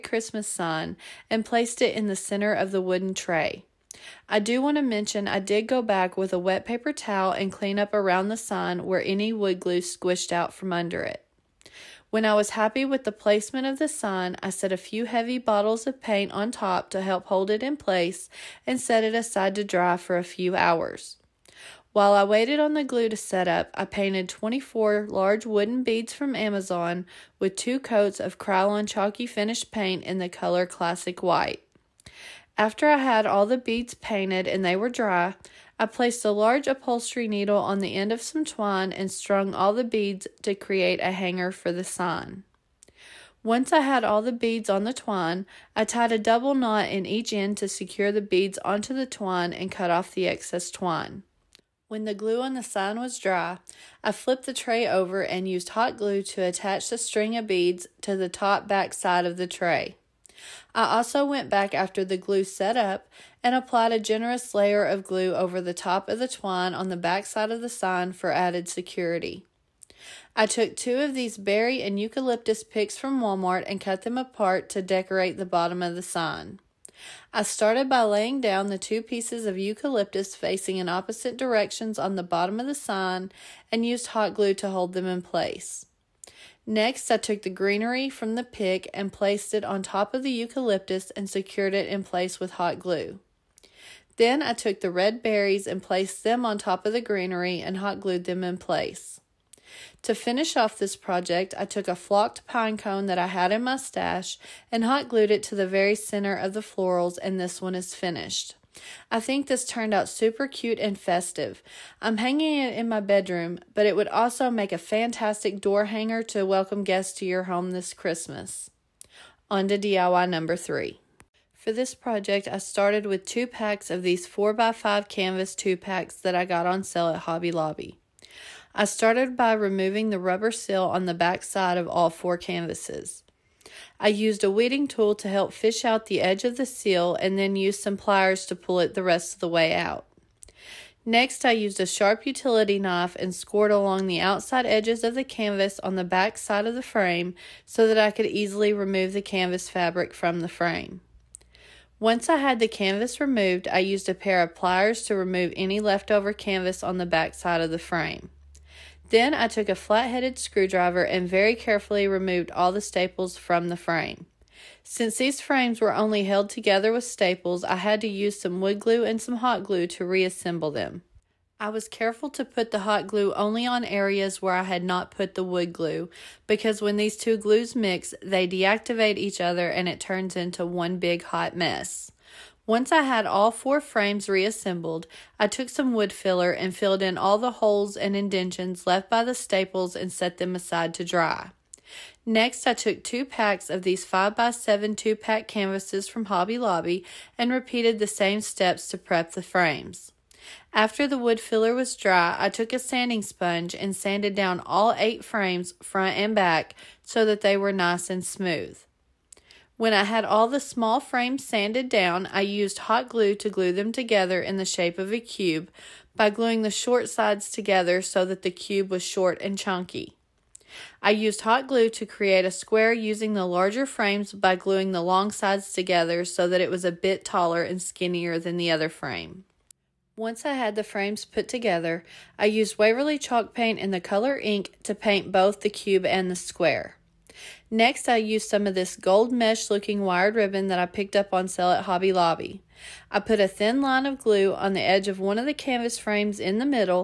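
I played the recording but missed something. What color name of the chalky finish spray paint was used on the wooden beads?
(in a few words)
Classic White.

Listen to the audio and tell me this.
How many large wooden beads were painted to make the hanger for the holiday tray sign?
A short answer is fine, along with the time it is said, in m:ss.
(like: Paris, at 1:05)
24, at 0:24.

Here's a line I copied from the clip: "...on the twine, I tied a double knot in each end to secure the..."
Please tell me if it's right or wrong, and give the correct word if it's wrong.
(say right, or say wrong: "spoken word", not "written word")
right.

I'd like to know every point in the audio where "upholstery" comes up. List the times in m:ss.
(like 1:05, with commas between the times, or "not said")
0:36.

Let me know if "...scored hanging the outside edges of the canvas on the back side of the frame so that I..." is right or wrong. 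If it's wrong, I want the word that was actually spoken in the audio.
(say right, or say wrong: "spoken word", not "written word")
wrong: "along", not "hanging".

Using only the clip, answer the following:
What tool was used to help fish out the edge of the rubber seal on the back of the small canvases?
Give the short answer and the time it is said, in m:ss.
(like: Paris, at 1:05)
weeding tool, at 2:14.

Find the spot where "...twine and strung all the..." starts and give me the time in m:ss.
0:38.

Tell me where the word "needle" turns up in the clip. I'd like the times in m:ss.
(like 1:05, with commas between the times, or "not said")
0:37.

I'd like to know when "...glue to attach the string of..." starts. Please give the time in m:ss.
0:55.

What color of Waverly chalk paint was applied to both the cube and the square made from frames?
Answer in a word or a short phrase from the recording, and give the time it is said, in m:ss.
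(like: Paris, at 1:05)
ink, at 3:54.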